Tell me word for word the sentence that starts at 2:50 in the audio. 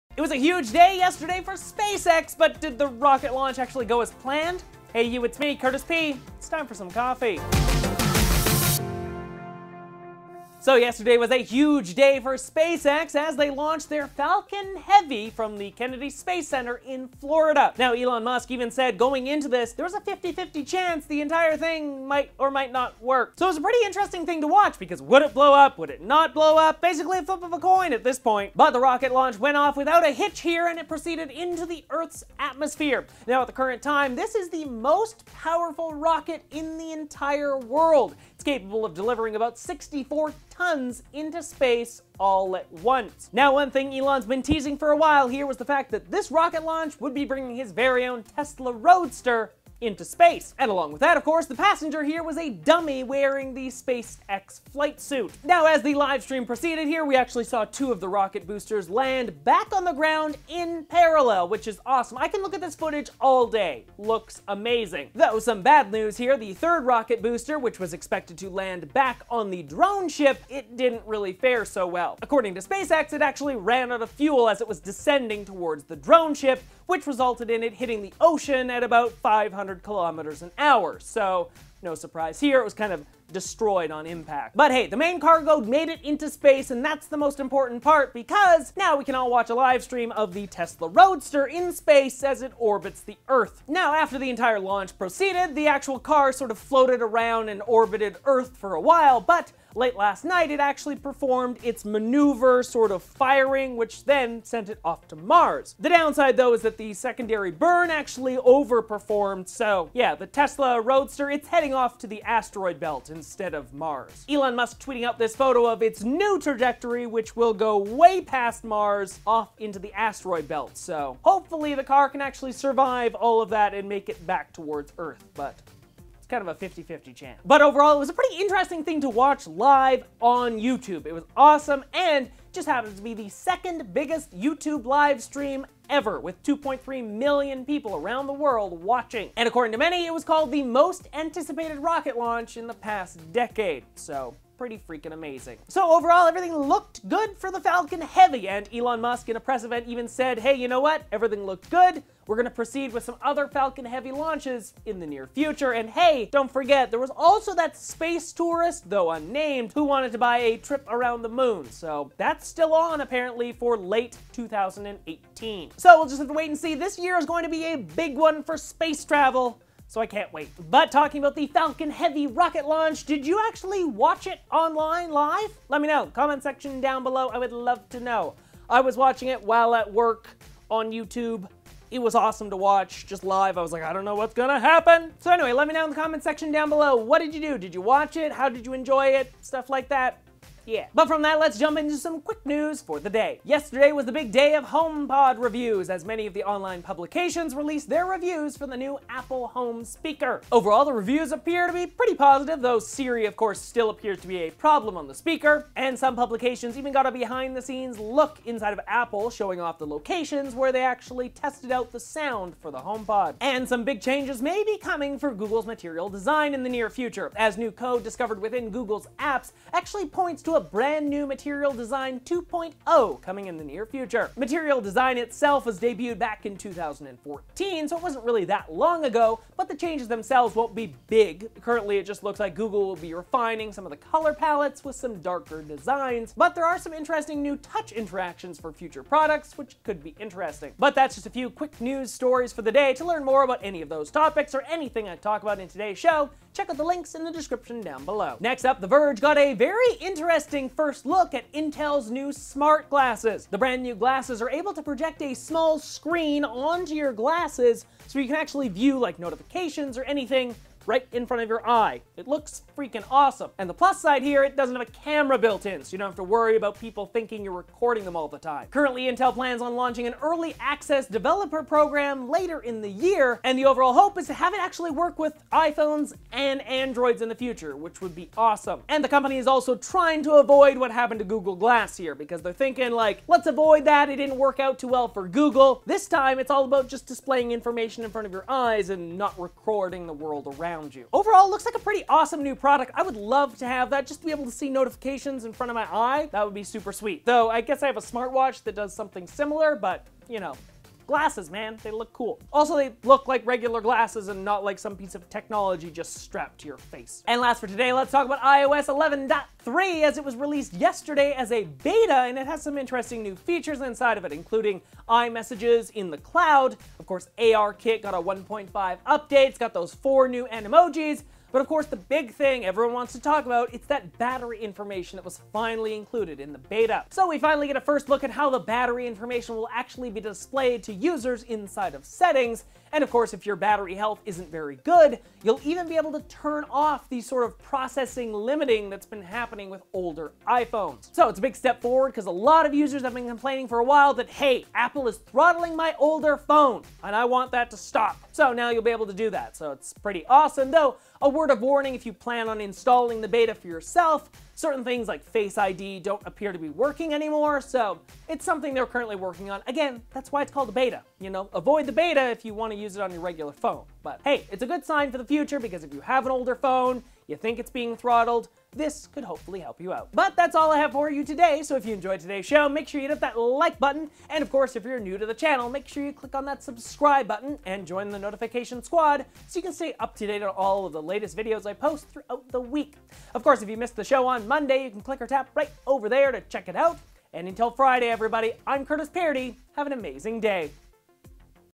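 But talking about the Falcon Heavy rocket launch, did you actually watch it online live?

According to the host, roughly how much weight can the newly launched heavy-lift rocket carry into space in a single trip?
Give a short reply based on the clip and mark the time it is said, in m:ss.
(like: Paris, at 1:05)
64 tons, at 0:39.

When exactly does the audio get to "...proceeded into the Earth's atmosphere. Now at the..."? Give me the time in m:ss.
0:30.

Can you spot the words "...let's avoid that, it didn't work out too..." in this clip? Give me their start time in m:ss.
4:43.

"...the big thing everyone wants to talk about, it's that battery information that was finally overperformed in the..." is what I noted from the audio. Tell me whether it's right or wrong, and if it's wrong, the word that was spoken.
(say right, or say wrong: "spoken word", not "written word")
wrong: "included", not "overperformed".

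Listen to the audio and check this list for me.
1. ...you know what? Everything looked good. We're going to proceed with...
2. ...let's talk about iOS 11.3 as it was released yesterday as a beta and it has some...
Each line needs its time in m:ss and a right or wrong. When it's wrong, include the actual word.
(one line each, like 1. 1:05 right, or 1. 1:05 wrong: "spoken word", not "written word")
1. 2:30 right
2. 5:07 right.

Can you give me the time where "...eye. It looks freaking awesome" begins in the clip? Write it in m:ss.
4:21.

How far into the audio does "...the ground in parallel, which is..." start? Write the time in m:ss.
0:59.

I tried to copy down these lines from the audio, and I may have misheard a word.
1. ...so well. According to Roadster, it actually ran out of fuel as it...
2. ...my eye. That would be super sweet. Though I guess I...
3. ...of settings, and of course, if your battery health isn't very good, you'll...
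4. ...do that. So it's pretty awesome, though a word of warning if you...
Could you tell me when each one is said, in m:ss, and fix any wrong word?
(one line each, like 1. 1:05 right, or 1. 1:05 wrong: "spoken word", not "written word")
1. 1:11 wrong: "SpaceX", not "Roadster"
2. 4:55 right
3. 5:31 right
4. 5:49 right.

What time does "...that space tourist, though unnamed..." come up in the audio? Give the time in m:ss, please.
2:37.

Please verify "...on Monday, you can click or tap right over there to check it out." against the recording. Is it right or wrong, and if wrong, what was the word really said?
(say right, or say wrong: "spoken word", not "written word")
right.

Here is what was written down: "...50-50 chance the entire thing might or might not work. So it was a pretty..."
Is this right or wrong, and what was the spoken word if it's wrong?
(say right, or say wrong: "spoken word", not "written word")
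right.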